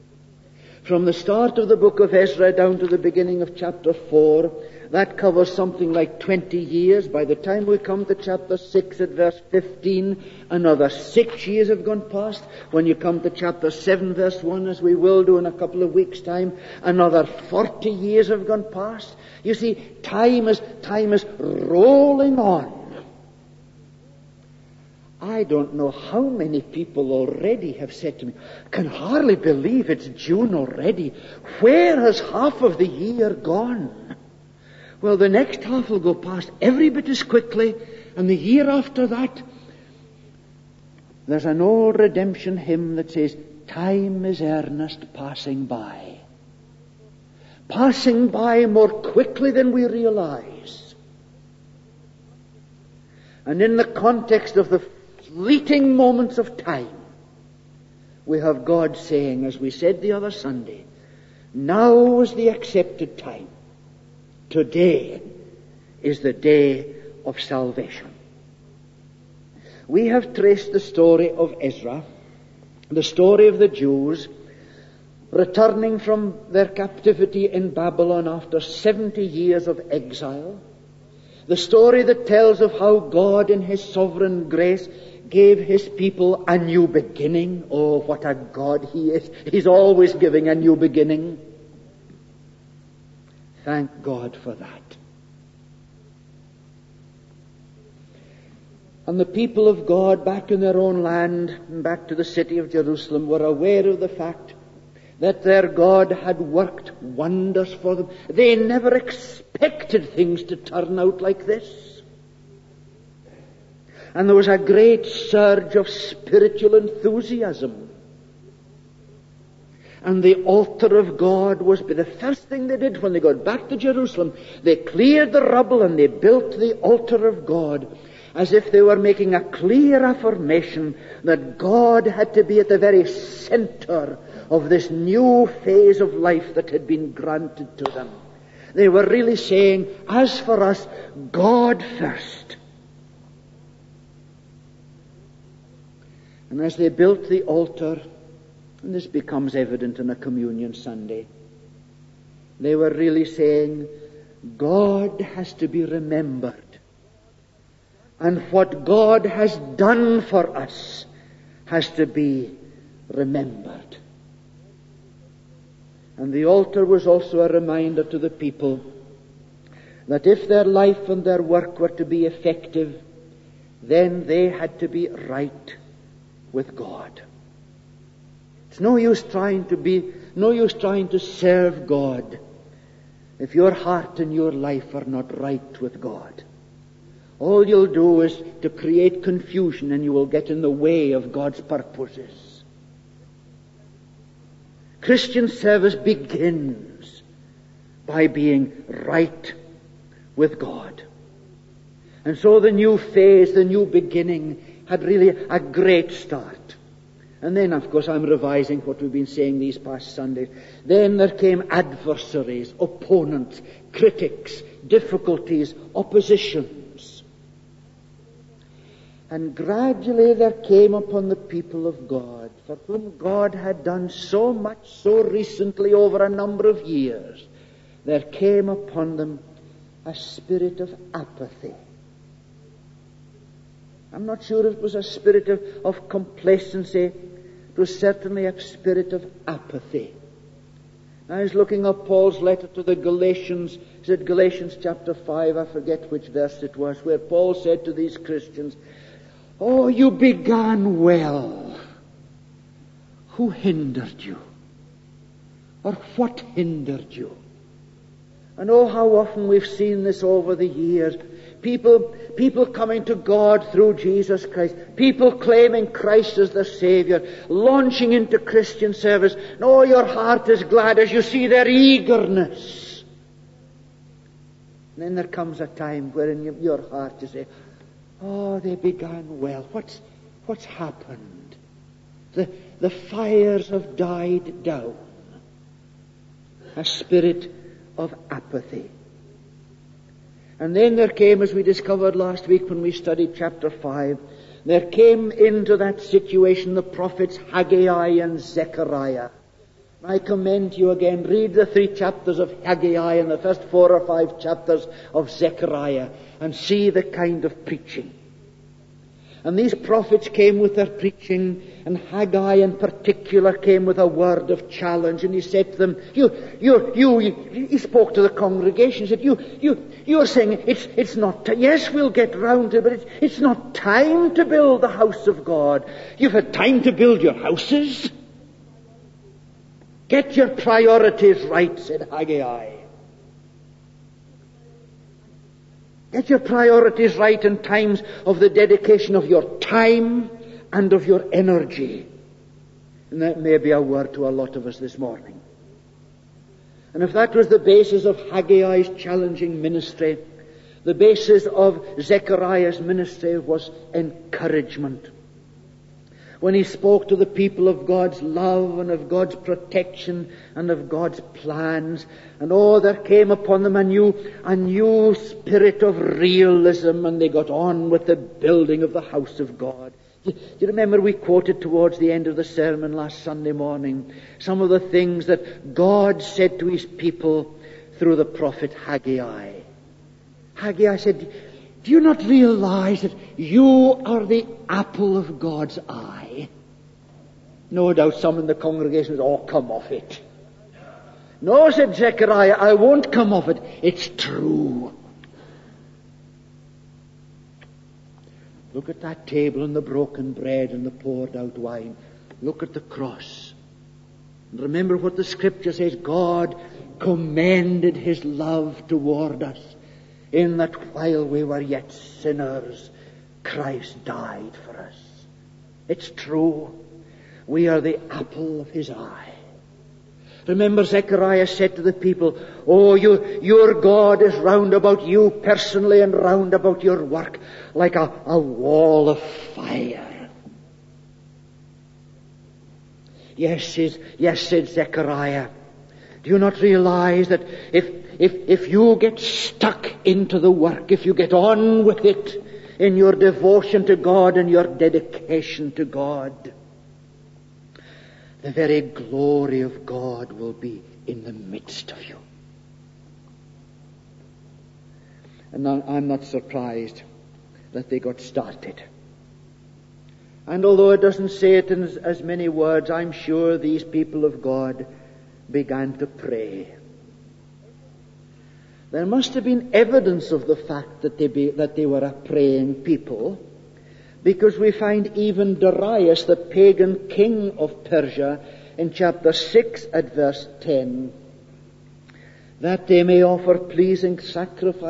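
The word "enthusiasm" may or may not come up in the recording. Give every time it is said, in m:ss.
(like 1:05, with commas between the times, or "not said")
1:56.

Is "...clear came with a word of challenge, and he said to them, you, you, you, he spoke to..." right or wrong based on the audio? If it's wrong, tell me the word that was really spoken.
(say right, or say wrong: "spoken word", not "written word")
wrong: "particular", not "clear".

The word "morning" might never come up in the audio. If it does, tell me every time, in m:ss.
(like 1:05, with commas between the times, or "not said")
5:44, 6:13.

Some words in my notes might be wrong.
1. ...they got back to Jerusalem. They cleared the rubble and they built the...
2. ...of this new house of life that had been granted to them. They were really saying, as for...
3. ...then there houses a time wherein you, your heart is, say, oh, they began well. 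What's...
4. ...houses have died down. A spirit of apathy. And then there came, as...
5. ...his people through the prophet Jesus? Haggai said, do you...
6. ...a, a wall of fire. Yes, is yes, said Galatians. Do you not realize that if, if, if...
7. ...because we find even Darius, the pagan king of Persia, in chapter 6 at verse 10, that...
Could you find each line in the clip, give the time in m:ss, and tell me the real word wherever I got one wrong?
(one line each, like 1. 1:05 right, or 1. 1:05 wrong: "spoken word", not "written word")
1. 2:03 right
2. 2:14 wrong: "phase", not "house"
3. 4:35 wrong: "comes", not "houses"
4. 4:42 wrong: "fires", not "houses"
5. 6:16 wrong: "Haggai", not "Jesus"
6. 7:07 wrong: "Zechariah", not "Galatians"
7. 7:54 right.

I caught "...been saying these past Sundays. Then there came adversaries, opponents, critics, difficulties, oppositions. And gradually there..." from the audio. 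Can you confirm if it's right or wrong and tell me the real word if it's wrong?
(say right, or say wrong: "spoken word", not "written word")
right.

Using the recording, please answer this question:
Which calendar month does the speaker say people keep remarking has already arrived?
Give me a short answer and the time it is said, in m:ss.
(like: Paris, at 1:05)
June, at 0:30.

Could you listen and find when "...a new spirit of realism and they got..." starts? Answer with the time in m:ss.
6:04.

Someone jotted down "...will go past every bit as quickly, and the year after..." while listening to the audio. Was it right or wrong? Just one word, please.
right.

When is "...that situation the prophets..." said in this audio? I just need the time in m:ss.
4:55.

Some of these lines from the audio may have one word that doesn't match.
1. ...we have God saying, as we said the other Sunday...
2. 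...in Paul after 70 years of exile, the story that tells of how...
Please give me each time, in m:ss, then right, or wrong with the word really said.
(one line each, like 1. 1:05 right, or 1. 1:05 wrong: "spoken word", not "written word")
1. 0:58 right
2. 1:17 wrong: "Babylon", not "Paul".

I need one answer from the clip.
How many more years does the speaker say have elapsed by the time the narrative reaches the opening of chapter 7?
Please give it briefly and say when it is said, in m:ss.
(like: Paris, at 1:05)
40, at 0:17.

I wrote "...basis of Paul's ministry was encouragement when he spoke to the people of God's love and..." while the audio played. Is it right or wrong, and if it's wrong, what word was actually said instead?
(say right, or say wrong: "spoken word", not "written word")
wrong: "Zechariah", not "Paul".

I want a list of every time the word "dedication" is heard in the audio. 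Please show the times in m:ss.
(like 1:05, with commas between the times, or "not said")
5:38, 7:24.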